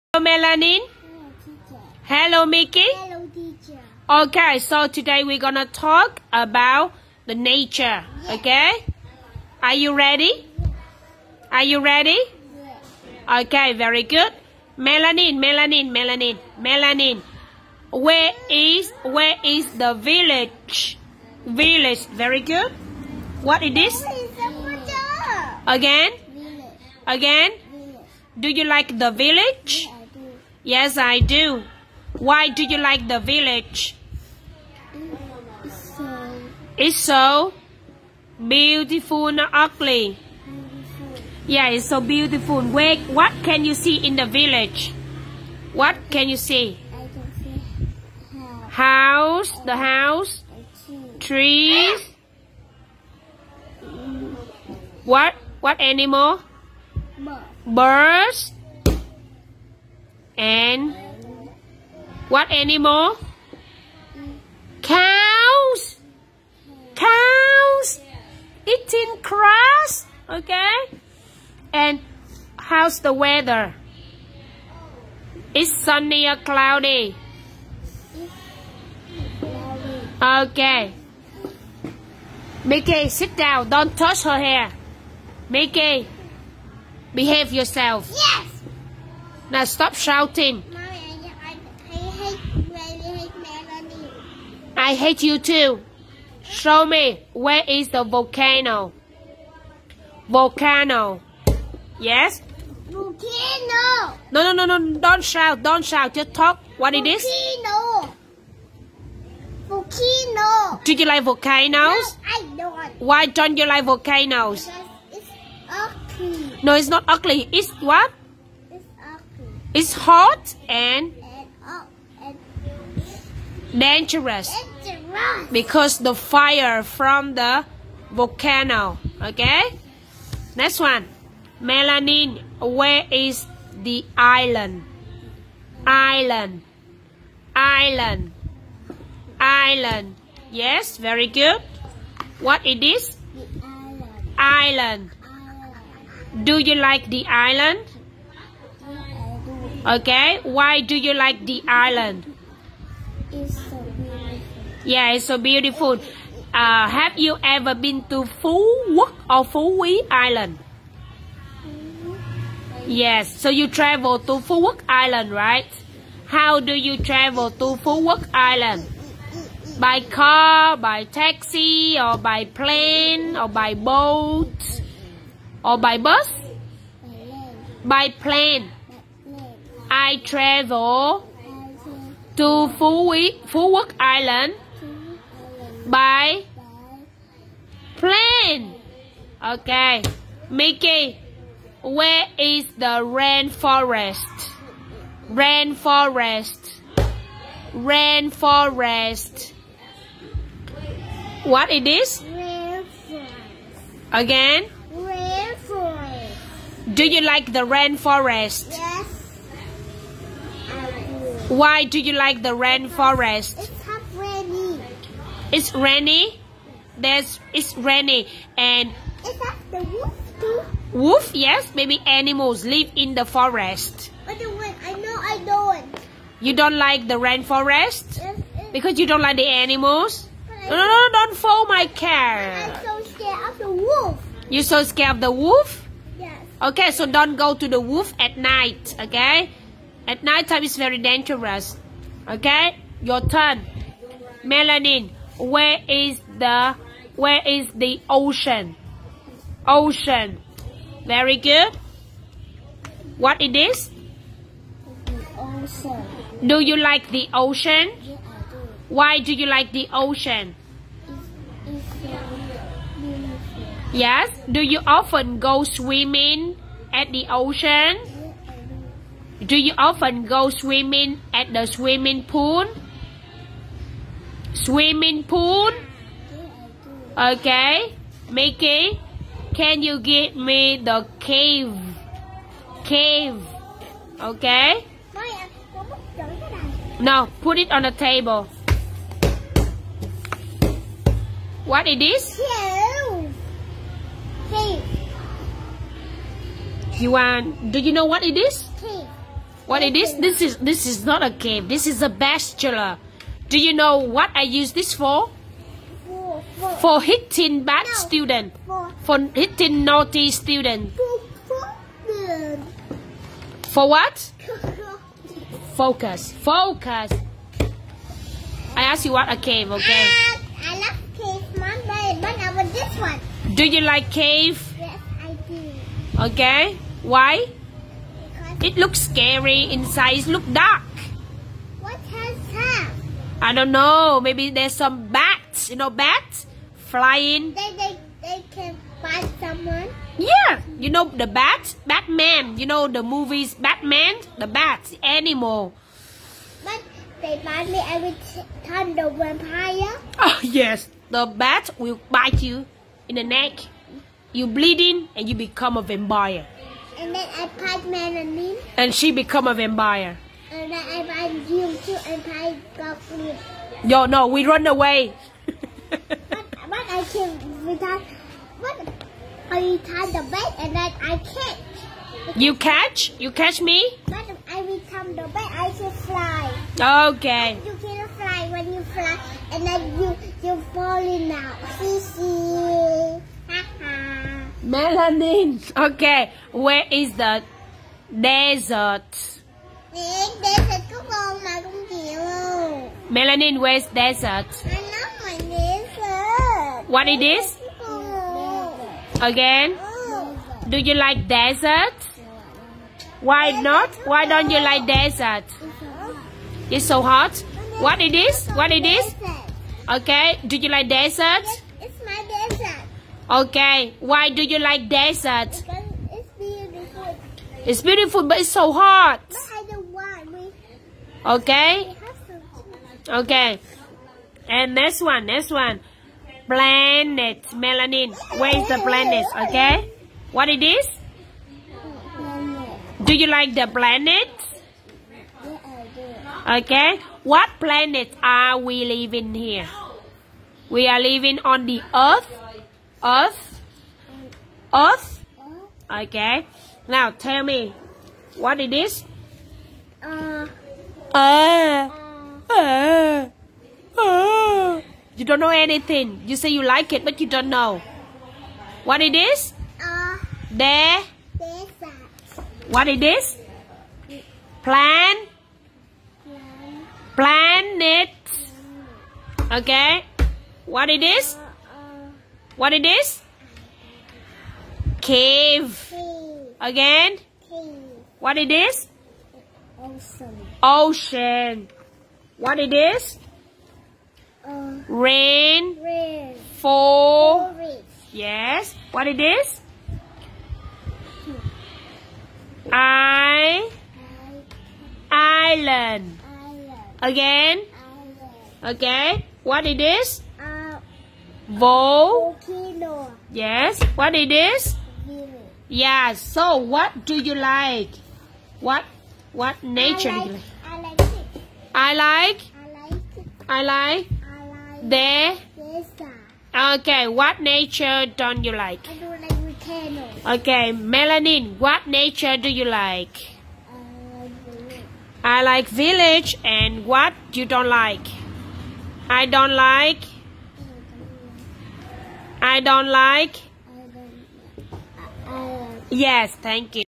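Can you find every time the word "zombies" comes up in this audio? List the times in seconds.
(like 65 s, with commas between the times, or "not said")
not said.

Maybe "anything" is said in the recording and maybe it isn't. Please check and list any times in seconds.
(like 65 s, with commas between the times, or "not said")
455 s.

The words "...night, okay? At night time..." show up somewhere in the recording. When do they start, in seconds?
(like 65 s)
238 s.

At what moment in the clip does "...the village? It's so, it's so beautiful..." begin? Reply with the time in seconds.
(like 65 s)
33 s.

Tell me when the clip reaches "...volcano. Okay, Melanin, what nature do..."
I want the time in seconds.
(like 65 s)
519 s.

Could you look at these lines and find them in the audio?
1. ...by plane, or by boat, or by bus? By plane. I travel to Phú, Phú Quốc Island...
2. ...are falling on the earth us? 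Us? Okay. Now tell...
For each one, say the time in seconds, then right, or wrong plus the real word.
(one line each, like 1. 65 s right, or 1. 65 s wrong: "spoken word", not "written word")
1. 172 s right
2. 440 s wrong: "living", not "falling".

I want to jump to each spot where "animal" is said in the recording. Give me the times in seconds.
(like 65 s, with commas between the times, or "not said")
55 s, 62 s, 222 s, 229 s, 345 s.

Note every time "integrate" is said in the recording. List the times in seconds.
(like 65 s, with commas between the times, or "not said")
not said.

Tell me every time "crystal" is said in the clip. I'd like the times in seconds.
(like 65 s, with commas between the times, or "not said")
not said.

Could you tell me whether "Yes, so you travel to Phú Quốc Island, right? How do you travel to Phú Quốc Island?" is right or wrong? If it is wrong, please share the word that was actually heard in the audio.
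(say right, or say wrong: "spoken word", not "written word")
right.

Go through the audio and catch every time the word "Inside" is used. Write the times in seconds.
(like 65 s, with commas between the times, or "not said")
329 s.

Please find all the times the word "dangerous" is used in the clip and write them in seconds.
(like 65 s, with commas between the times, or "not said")
123 s, 240 s.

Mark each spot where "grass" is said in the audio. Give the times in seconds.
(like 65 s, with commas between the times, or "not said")
69 s.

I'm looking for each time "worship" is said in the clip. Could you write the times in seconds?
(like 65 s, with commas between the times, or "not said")
not said.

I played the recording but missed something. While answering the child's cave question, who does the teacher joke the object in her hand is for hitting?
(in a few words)
naughty student.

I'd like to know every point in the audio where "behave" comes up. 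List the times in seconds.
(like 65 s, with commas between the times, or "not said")
87 s.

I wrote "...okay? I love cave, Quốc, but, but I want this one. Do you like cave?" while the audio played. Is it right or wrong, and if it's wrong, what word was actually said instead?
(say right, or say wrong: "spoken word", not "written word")
wrong: "Mom", not "Quốc".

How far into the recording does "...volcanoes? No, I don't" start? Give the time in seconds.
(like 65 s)
111 s.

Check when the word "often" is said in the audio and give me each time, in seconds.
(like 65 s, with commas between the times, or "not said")
264 s, 269 s.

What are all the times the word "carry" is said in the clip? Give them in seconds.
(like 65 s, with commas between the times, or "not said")
not said.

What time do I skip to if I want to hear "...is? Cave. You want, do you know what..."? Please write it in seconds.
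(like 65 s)
291 s.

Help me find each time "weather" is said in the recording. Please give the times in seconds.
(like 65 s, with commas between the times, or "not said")
73 s.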